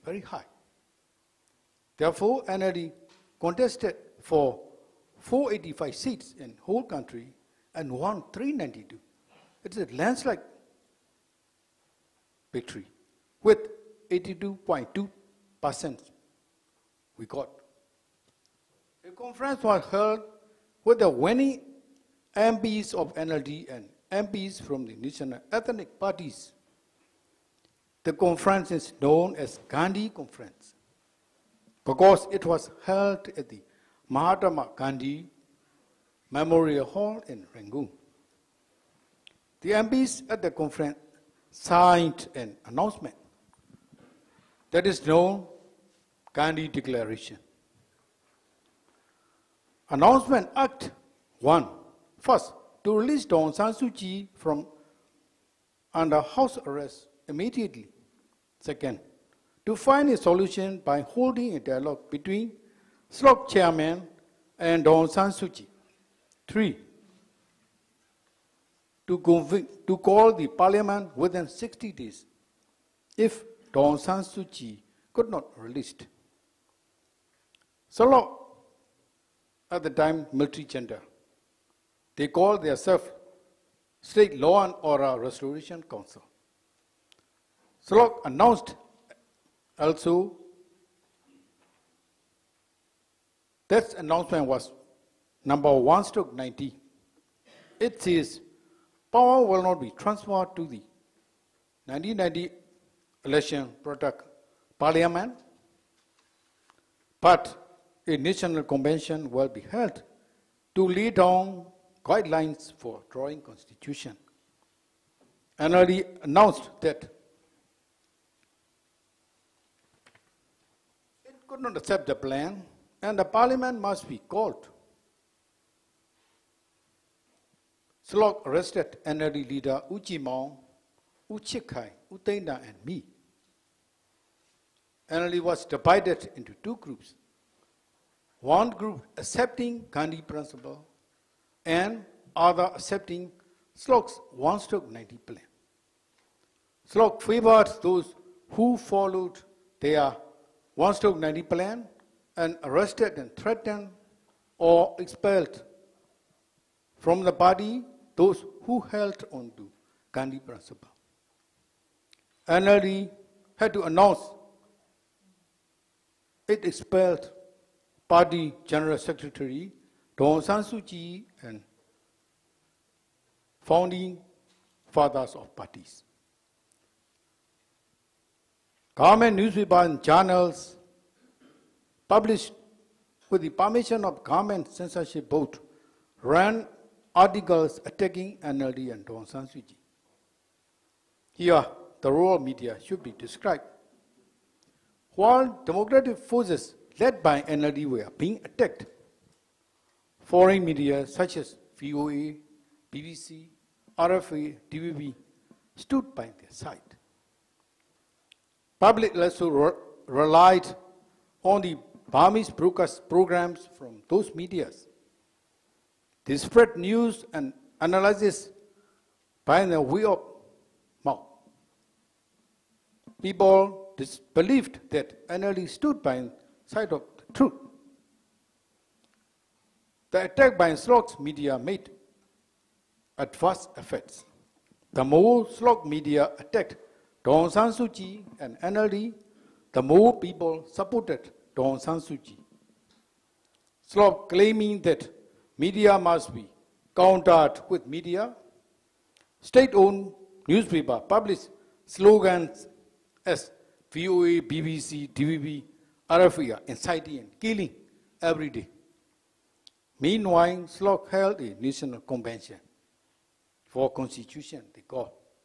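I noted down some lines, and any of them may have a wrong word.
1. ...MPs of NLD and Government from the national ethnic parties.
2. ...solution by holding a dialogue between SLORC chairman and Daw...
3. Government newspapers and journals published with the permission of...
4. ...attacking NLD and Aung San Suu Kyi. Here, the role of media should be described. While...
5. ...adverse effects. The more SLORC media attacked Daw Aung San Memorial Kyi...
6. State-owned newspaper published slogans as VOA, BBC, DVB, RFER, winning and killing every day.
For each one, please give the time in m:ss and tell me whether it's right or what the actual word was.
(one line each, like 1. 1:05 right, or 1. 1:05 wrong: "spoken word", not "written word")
1. 0:22 wrong: "MPs", not "Government"
2. 1:00 right
3. 2:58 right
4. 3:07 right
5. 3:53 wrong: "Suu", not "Memorial"
6. 4:09 wrong: "inciting", not "winning".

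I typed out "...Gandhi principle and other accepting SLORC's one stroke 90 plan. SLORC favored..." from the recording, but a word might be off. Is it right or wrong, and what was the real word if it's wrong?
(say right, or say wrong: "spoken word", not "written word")
right.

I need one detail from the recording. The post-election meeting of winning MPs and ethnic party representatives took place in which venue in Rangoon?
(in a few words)
Mahatma Gandhi Memorial Hall.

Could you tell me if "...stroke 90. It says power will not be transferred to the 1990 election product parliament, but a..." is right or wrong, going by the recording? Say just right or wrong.
right.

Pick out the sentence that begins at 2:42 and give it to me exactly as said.
NLD had to announce it expelled party general secretary Daw Aung San Suu Kyi and founding fathers of parties.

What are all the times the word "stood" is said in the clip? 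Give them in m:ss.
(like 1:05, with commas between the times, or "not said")
3:25, 3:45.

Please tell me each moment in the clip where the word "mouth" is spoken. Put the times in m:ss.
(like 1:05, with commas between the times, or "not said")
3:41.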